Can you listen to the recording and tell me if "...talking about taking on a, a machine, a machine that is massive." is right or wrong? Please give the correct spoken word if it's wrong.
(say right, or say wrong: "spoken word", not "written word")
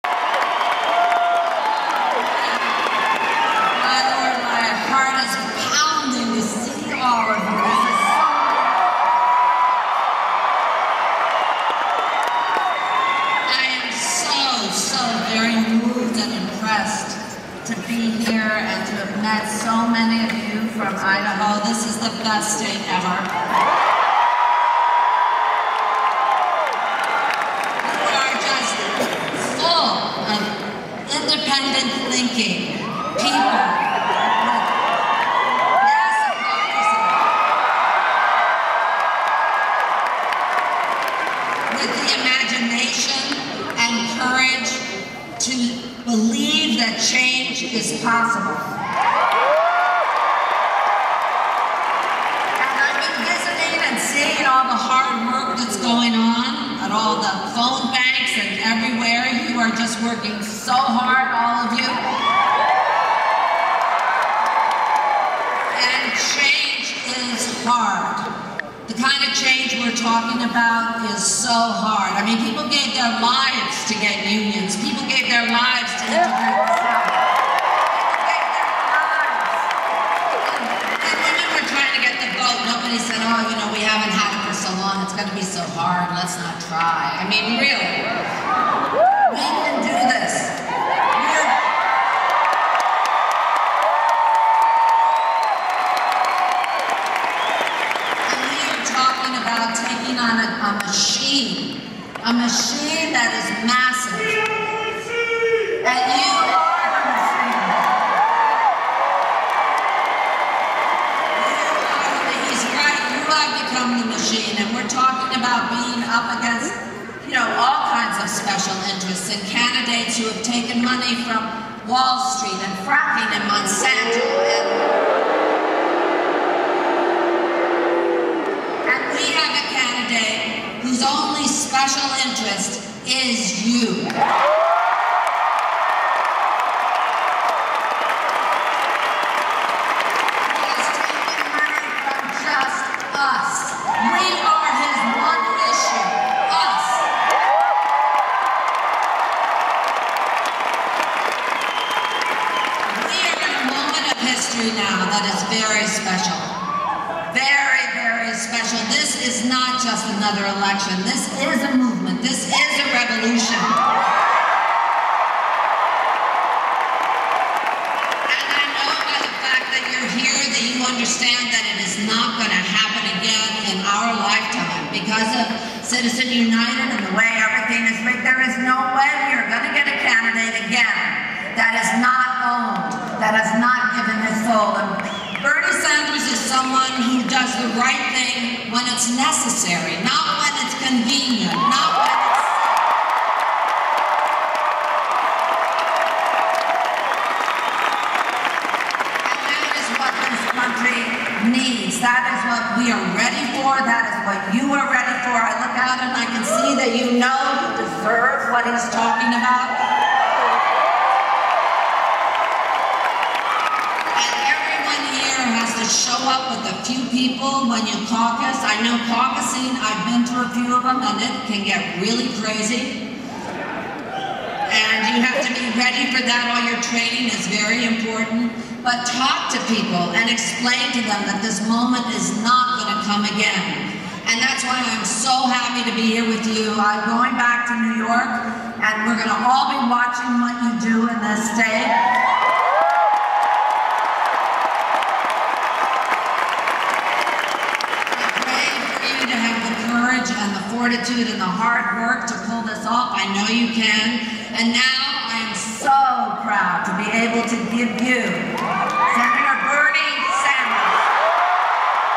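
right.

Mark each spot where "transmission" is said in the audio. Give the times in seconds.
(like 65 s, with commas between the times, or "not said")
not said.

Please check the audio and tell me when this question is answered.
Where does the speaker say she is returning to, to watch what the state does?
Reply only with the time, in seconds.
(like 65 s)
237 s.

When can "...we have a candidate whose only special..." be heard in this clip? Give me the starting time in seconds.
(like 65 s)
129 s.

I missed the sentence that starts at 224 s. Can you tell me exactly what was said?
And you have to be ready for that.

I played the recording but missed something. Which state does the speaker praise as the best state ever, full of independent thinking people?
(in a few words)
Idaho.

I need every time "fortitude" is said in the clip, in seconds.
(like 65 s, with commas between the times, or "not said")
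250 s.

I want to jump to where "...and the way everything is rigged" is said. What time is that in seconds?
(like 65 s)
177 s.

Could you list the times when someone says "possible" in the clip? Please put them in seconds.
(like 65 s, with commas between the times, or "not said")
48 s.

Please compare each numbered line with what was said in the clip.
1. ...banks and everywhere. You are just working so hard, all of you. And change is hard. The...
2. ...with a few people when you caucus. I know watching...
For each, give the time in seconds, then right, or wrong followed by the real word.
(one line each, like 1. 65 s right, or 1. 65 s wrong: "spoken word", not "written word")
1. 57 s right
2. 216 s wrong: "caucusing", not "watching".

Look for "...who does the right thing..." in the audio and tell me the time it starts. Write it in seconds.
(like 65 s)
187 s.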